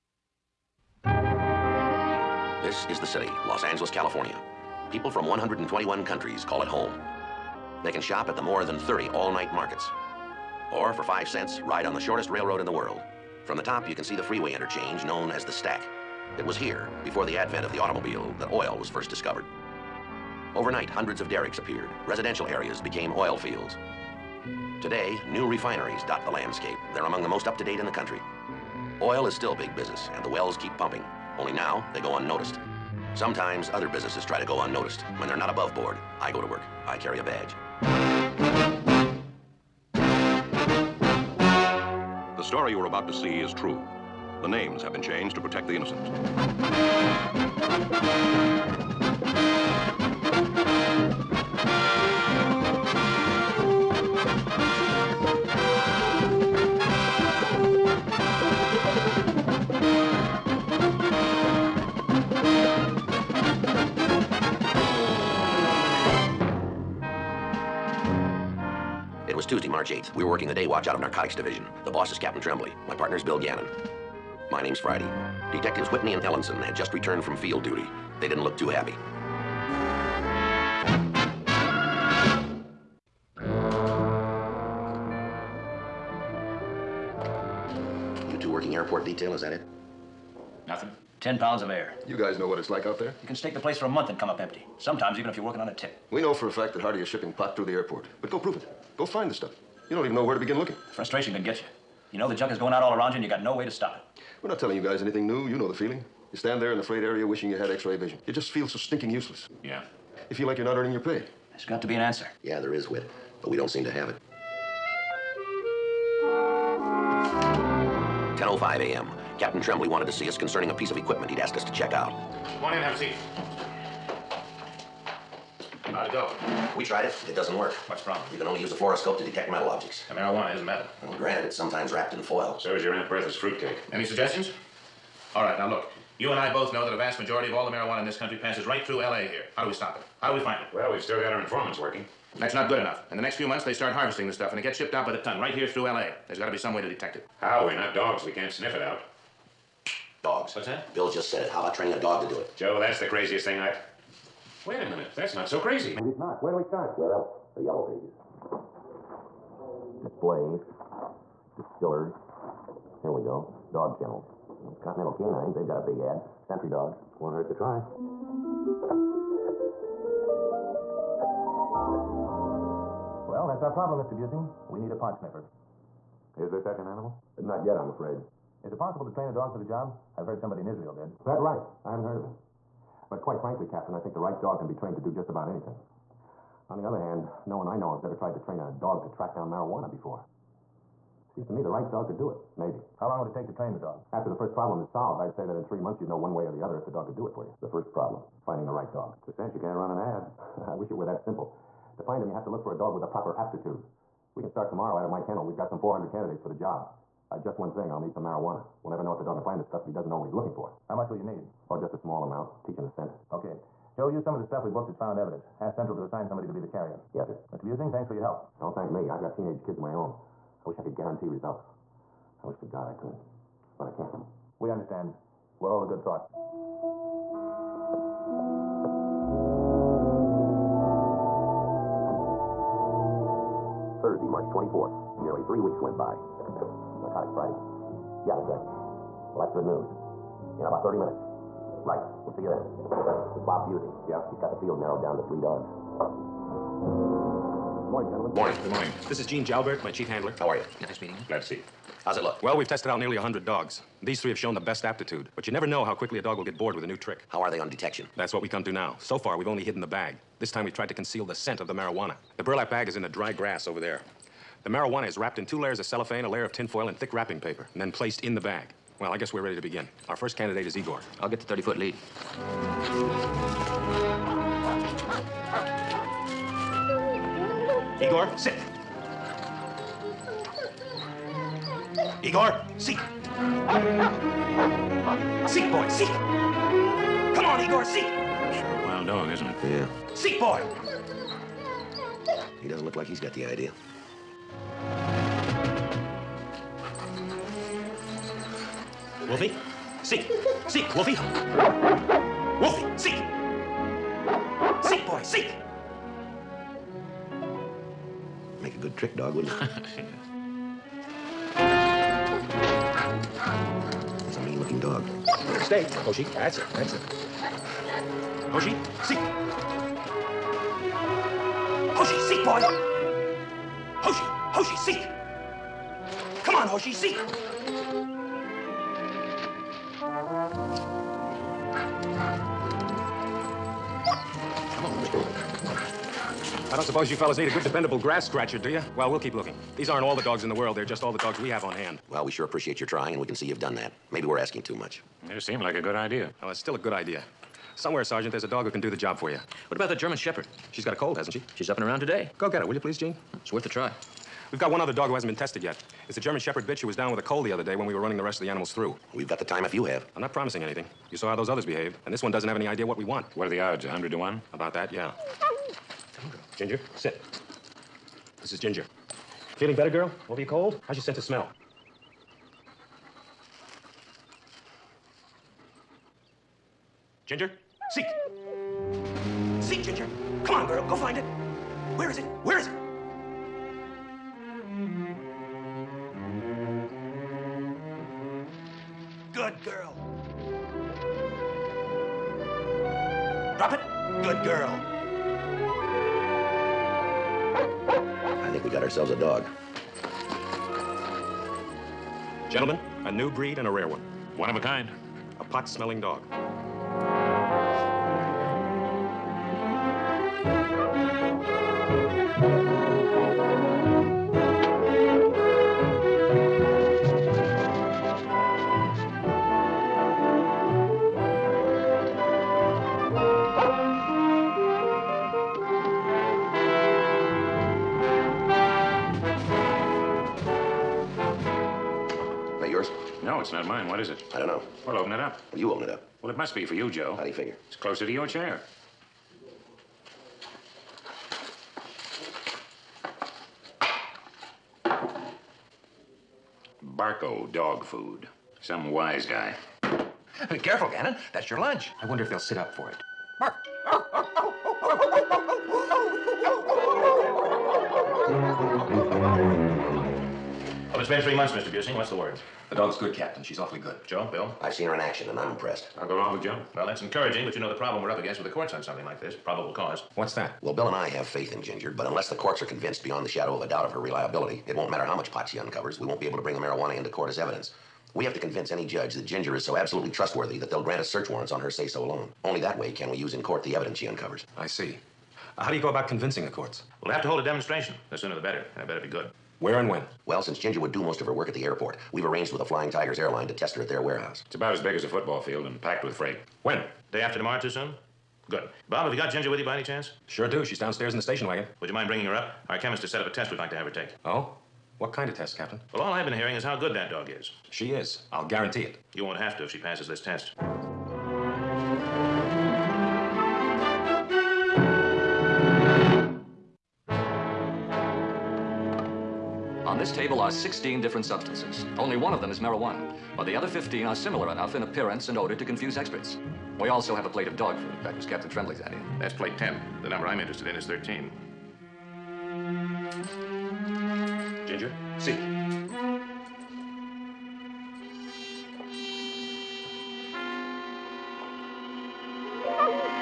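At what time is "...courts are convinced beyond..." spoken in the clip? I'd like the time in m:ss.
7:52.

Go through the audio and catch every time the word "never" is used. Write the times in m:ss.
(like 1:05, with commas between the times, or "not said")
3:28, 4:15.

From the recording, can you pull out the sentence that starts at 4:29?
Well, I guess we're ready to begin.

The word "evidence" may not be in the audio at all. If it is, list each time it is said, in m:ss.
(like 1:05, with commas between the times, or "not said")
3:35, 7:57, 8:03.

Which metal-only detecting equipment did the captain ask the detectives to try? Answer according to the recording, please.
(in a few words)
Fluoroscope.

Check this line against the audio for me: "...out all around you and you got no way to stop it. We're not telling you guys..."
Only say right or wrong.
right.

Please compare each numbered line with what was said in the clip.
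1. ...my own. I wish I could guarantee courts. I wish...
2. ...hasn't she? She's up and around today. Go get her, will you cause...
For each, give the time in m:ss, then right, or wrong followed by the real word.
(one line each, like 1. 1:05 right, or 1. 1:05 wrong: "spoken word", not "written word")
1. 3:39 wrong: "results", not "courts"
2. 5:51 wrong: "please", not "cause".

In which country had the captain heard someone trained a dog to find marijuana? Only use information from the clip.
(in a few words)
Israel.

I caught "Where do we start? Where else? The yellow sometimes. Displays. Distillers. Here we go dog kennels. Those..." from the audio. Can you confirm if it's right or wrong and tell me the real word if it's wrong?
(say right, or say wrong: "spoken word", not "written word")
wrong: "pages", not "sometimes".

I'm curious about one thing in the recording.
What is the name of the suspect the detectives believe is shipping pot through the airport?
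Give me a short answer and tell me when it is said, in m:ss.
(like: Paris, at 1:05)
Hardy, at 1:36.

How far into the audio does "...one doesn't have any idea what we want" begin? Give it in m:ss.
6:02.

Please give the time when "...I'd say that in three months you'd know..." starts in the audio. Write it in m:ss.
3:15.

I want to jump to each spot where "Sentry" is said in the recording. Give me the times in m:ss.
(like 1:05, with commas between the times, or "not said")
2:46.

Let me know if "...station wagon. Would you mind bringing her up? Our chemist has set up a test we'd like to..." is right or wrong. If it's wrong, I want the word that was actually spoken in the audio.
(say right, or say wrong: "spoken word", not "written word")
right.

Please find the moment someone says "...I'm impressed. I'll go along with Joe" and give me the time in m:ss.
7:45.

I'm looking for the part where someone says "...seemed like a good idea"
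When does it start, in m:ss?
5:45.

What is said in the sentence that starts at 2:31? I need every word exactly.
How about training a dog to do it?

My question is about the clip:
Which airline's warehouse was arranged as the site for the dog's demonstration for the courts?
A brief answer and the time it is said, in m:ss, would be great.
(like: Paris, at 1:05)
Flying Tigers, at 8:12.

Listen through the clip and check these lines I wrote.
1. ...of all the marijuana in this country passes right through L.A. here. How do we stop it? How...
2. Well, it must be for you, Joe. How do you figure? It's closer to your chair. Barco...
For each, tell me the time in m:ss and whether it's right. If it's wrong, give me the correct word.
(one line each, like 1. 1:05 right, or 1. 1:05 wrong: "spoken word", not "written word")
1. 2:17 right
2. 7:16 right.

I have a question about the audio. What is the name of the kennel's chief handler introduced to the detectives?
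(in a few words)
Gene Jalbert.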